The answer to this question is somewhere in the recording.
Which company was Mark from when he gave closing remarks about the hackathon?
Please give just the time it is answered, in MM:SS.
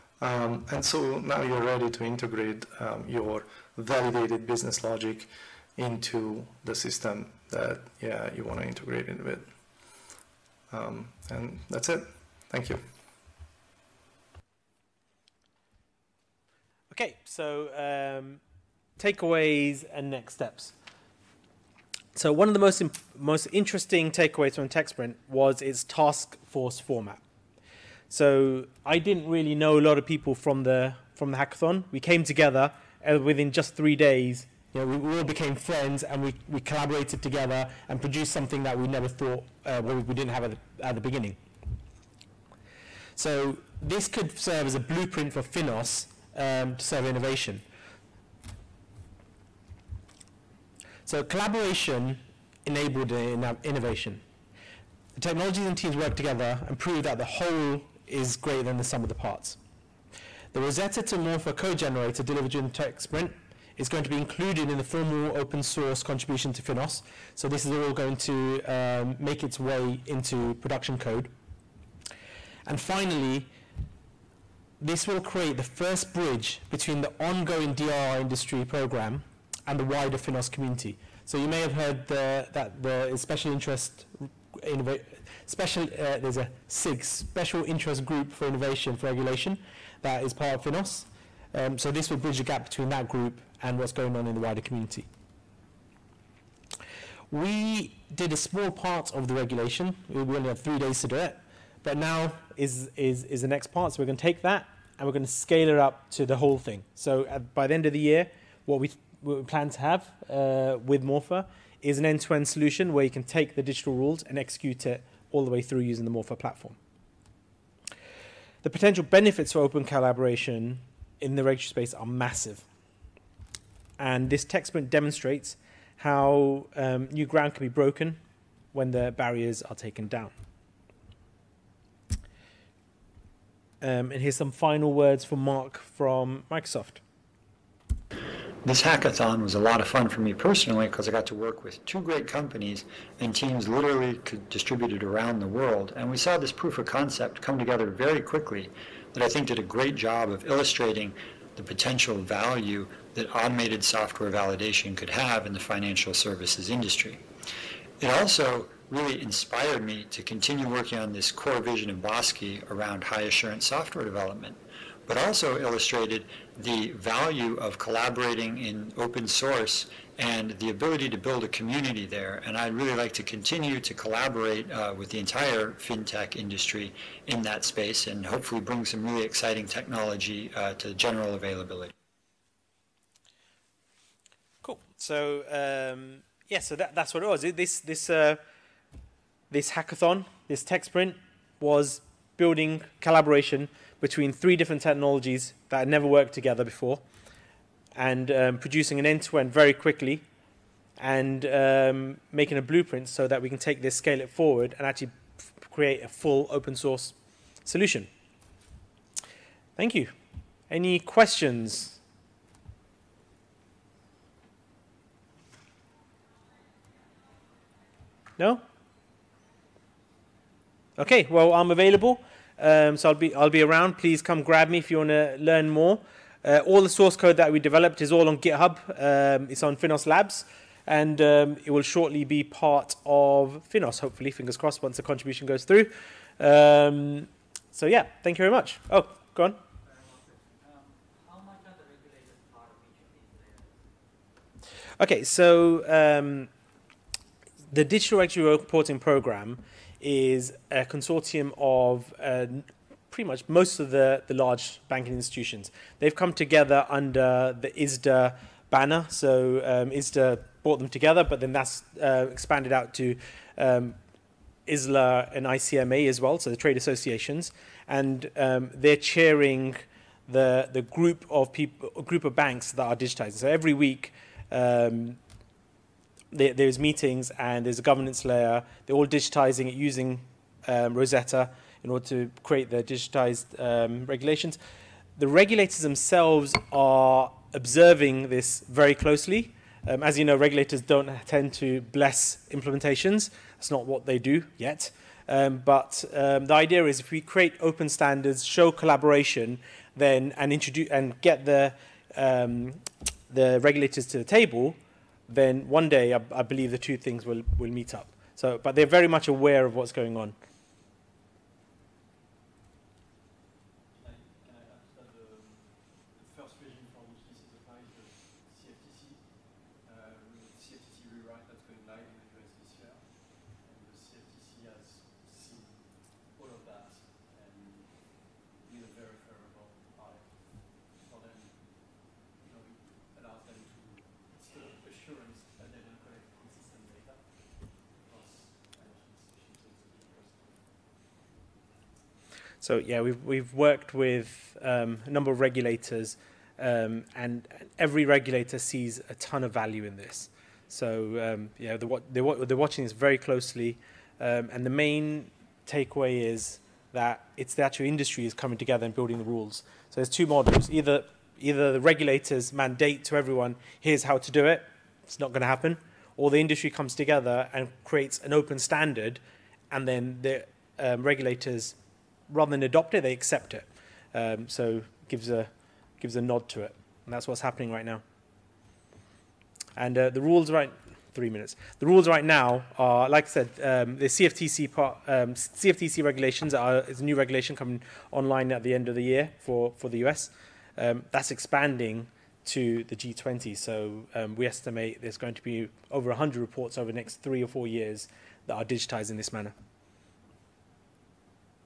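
02:16.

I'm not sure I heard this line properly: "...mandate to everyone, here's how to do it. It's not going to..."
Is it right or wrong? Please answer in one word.
right.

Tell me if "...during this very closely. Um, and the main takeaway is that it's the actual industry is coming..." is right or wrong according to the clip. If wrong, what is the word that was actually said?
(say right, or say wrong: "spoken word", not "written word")
wrong: "watching", not "during".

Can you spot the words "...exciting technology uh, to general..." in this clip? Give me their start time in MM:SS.
02:59.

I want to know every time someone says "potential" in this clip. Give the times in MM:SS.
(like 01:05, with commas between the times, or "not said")
01:58, 02:31.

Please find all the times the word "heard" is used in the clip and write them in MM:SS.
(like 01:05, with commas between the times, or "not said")
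01:21.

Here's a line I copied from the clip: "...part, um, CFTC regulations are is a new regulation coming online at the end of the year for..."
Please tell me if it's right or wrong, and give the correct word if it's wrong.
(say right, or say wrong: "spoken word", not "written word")
right.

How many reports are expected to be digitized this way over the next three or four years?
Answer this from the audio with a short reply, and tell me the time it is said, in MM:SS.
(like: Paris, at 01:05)
Over 100, at 06:35.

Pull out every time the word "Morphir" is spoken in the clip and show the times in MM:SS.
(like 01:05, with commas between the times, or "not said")
01:01, 01:51, 01:56.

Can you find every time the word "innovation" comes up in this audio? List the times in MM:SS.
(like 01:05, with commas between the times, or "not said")
00:47, 00:53, 01:28.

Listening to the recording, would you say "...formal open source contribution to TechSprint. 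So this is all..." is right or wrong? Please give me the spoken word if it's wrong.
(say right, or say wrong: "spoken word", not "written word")
wrong: "Finos", not "TechSprint".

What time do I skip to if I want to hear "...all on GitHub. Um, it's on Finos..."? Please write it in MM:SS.
03:48.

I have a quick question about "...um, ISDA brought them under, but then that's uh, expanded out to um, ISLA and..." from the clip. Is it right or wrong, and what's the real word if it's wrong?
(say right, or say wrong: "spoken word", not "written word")
wrong: "together", not "under".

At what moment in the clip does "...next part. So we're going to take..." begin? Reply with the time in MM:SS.
01:43.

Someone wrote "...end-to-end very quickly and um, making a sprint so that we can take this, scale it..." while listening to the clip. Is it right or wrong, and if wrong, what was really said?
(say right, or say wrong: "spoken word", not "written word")
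wrong: "blueprint", not "sprint".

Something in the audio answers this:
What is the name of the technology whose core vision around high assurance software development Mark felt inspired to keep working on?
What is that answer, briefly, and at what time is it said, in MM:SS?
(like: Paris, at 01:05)
Bosque, at 02:42.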